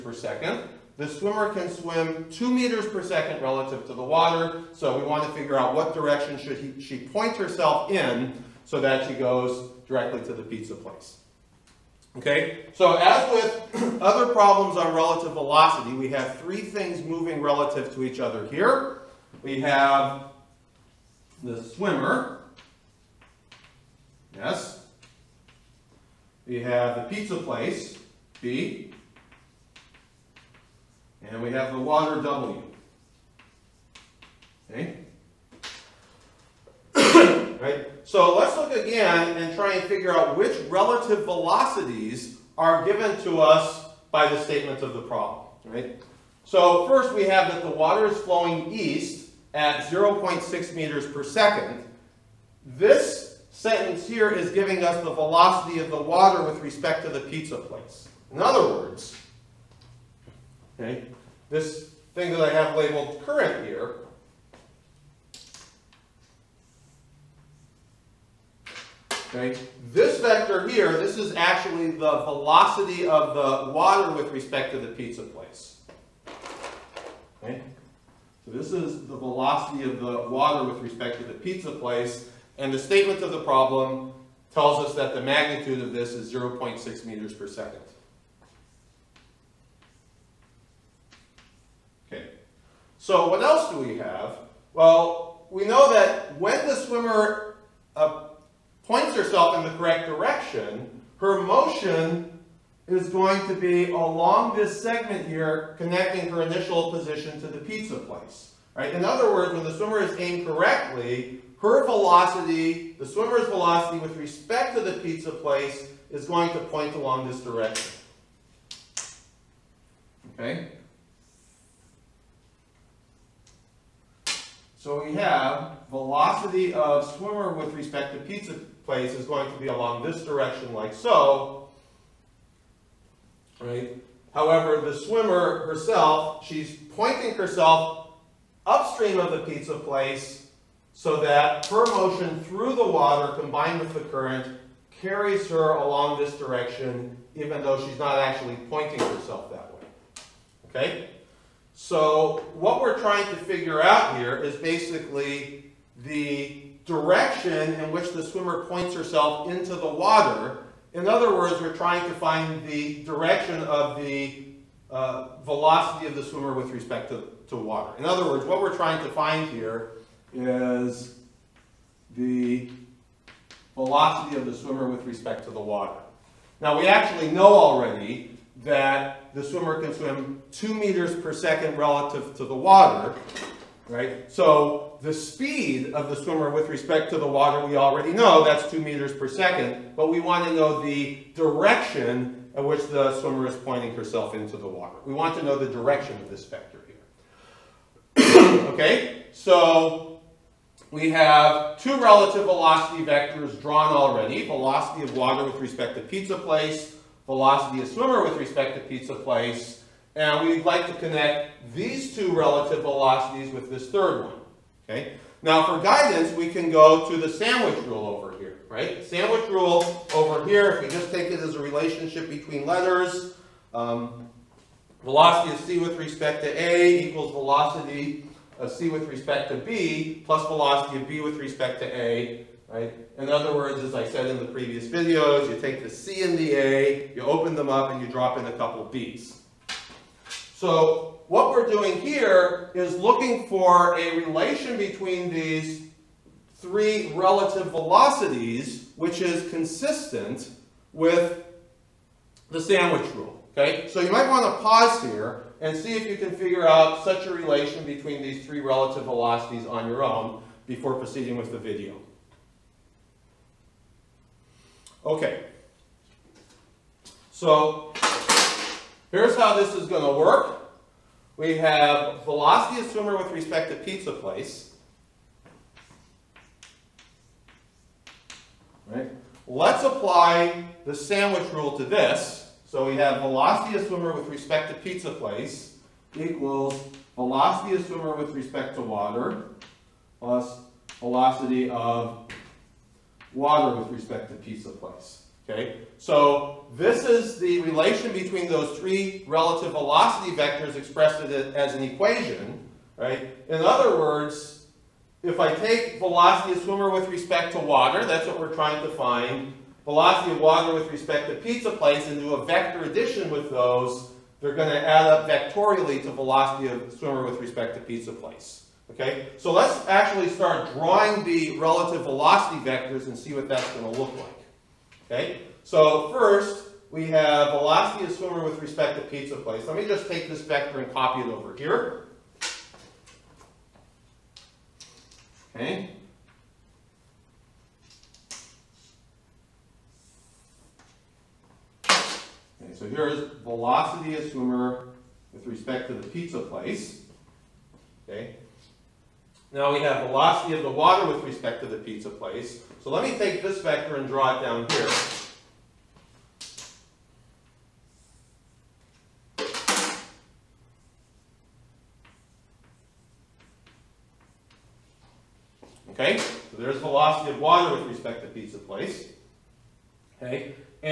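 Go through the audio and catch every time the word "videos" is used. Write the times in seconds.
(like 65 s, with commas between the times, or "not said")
234 s, 261 s.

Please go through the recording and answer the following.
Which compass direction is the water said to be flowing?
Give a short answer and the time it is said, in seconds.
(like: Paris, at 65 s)
east, at 48 s.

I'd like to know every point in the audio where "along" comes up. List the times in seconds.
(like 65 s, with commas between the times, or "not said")
103 s, 116 s, 129 s, 145 s.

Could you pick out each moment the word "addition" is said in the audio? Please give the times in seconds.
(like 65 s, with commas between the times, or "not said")
312 s.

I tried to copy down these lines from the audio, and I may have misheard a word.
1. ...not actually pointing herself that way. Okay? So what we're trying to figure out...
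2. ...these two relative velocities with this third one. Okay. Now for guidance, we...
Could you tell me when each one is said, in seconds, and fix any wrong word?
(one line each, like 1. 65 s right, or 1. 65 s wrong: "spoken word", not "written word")
1. 147 s right
2. 211 s right.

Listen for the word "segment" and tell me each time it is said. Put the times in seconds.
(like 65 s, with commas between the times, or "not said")
104 s.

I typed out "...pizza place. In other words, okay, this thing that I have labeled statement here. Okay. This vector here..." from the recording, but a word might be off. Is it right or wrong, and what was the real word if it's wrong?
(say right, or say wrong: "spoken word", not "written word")
wrong: "current", not "statement".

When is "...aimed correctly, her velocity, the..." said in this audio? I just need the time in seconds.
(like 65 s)
110 s.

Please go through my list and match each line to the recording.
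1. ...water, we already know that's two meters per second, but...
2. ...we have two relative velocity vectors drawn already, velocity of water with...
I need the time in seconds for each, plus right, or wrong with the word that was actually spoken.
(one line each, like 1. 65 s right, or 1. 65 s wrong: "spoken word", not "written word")
1. 187 s right
2. 200 s right.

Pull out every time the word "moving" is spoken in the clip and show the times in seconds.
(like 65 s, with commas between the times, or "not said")
17 s.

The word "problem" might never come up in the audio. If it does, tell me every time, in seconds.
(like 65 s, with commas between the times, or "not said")
14 s, 45 s, 83 s.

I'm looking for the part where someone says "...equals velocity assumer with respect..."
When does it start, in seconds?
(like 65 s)
286 s.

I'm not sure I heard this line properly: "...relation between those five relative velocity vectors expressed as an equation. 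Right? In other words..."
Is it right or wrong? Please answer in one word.
wrong.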